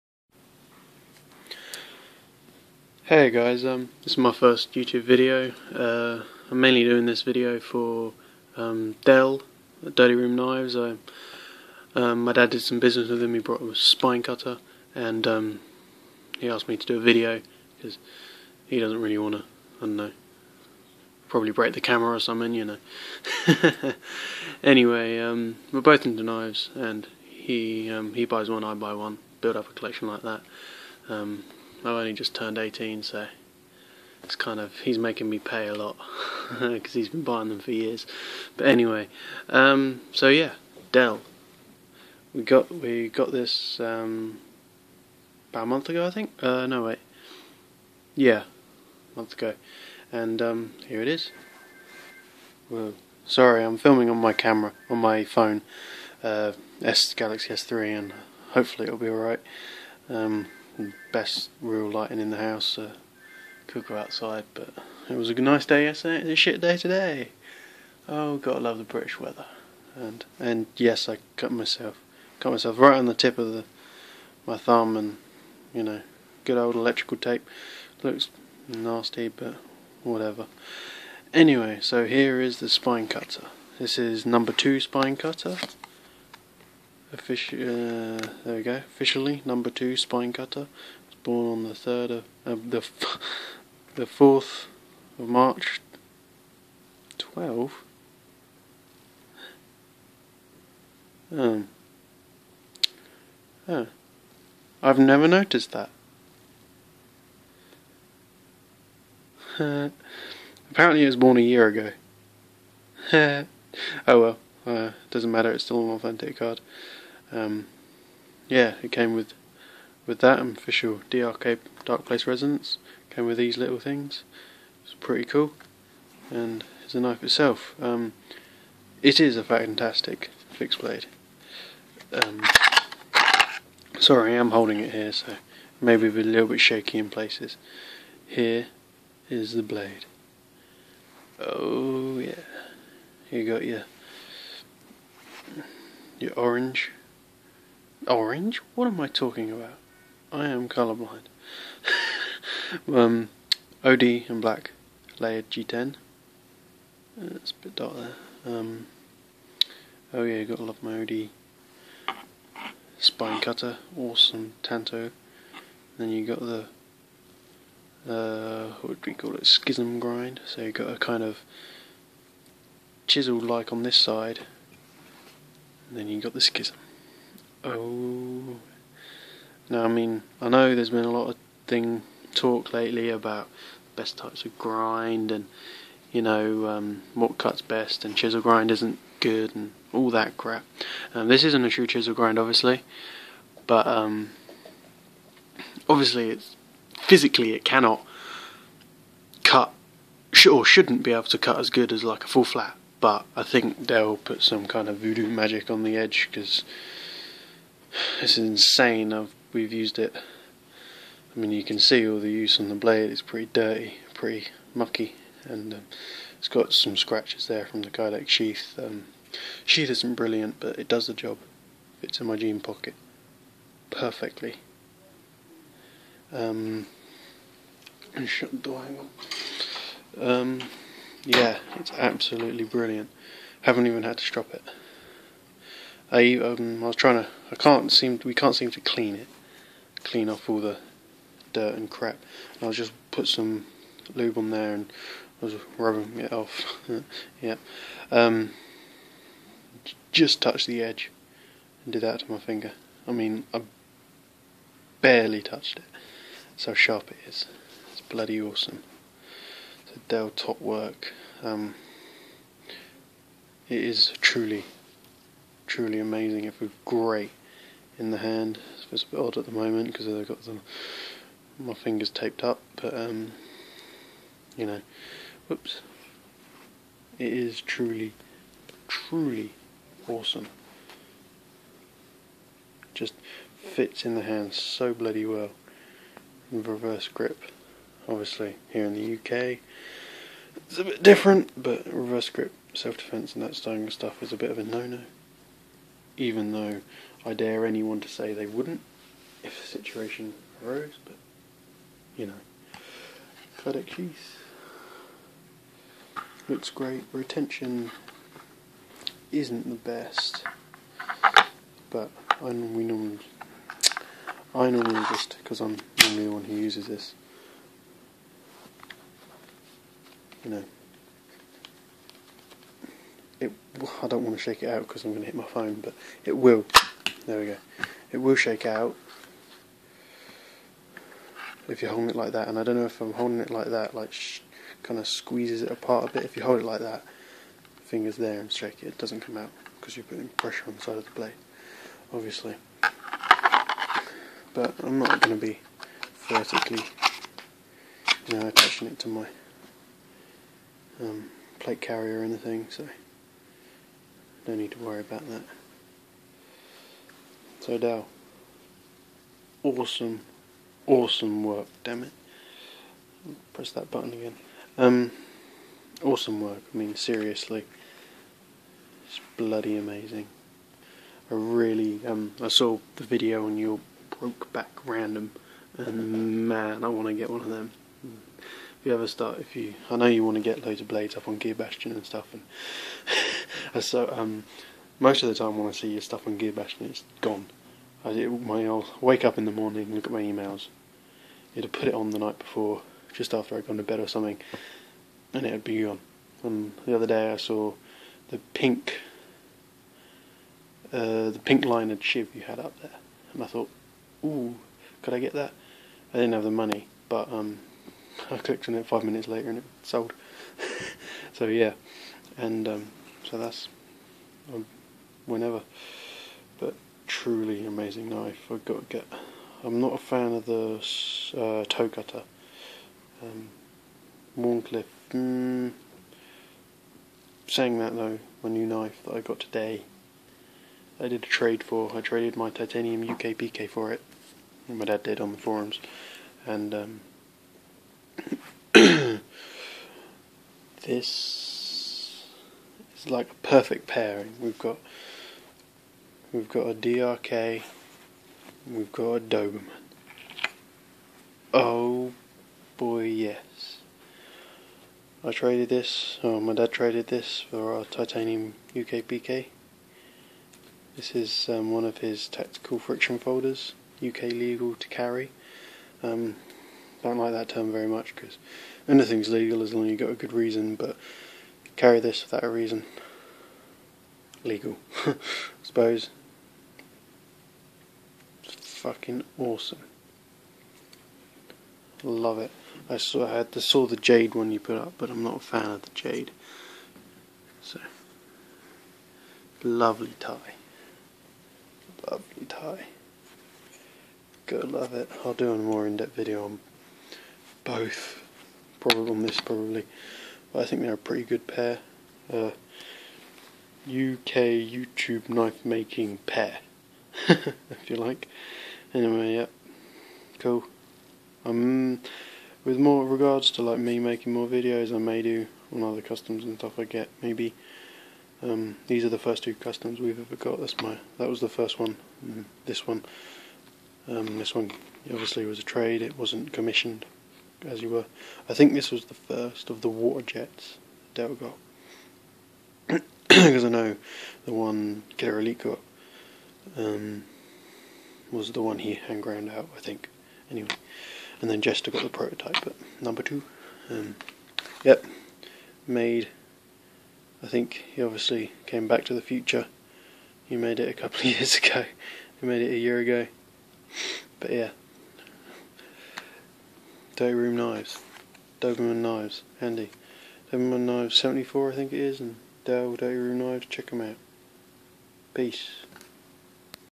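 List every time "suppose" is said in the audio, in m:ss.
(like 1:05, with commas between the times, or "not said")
7:55.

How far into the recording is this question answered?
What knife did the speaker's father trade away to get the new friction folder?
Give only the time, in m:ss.
7:12.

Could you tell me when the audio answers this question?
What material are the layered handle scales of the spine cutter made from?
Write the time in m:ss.
2:35.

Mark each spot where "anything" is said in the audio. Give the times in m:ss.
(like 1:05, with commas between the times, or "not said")
5:52, 7:48.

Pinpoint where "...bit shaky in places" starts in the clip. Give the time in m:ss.
2:16.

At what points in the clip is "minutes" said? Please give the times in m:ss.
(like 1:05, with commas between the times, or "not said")
6:49.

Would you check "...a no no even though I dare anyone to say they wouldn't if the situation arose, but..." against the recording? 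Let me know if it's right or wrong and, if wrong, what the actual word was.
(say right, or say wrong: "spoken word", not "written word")
right.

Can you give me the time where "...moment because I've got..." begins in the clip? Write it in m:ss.
4:29.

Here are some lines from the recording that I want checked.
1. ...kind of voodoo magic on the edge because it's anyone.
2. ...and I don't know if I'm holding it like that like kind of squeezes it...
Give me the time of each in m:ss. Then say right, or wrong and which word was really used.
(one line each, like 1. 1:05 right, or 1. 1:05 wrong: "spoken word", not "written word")
1. 3:24 wrong: "insane", not "anyone"
2. 5:32 right.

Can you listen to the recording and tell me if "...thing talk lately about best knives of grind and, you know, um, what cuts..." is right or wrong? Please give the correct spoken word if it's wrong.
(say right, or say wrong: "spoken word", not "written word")
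wrong: "types", not "knives".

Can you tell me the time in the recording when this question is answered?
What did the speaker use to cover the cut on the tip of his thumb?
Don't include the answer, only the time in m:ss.
1:16.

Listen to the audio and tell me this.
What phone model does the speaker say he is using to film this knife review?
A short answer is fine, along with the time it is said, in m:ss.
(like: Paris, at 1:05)
Galaxy S3, at 0:56.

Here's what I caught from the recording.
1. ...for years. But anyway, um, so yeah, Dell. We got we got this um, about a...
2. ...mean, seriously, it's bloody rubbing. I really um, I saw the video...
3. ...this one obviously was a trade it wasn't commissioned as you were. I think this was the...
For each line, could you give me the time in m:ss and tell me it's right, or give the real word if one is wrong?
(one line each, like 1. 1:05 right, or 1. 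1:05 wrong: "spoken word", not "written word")
1. 0:37 right
2. 6:06 wrong: "amazing", not "rubbing"
3. 8:44 right.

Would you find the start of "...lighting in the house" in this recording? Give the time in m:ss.
1:01.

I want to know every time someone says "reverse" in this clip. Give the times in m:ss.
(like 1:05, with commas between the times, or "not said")
4:46, 4:51.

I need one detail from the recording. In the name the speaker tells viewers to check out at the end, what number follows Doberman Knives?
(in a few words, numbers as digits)
74.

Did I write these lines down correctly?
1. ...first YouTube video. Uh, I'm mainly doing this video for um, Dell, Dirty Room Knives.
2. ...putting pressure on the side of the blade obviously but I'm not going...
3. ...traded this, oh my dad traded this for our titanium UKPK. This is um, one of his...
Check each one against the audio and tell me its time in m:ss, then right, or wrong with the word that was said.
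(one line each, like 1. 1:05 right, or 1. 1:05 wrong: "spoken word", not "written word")
1. 0:04 right
2. 5:40 right
3. 7:35 right.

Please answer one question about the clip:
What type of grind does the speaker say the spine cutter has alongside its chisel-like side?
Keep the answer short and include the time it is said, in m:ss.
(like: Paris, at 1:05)
Schism grind, at 2:49.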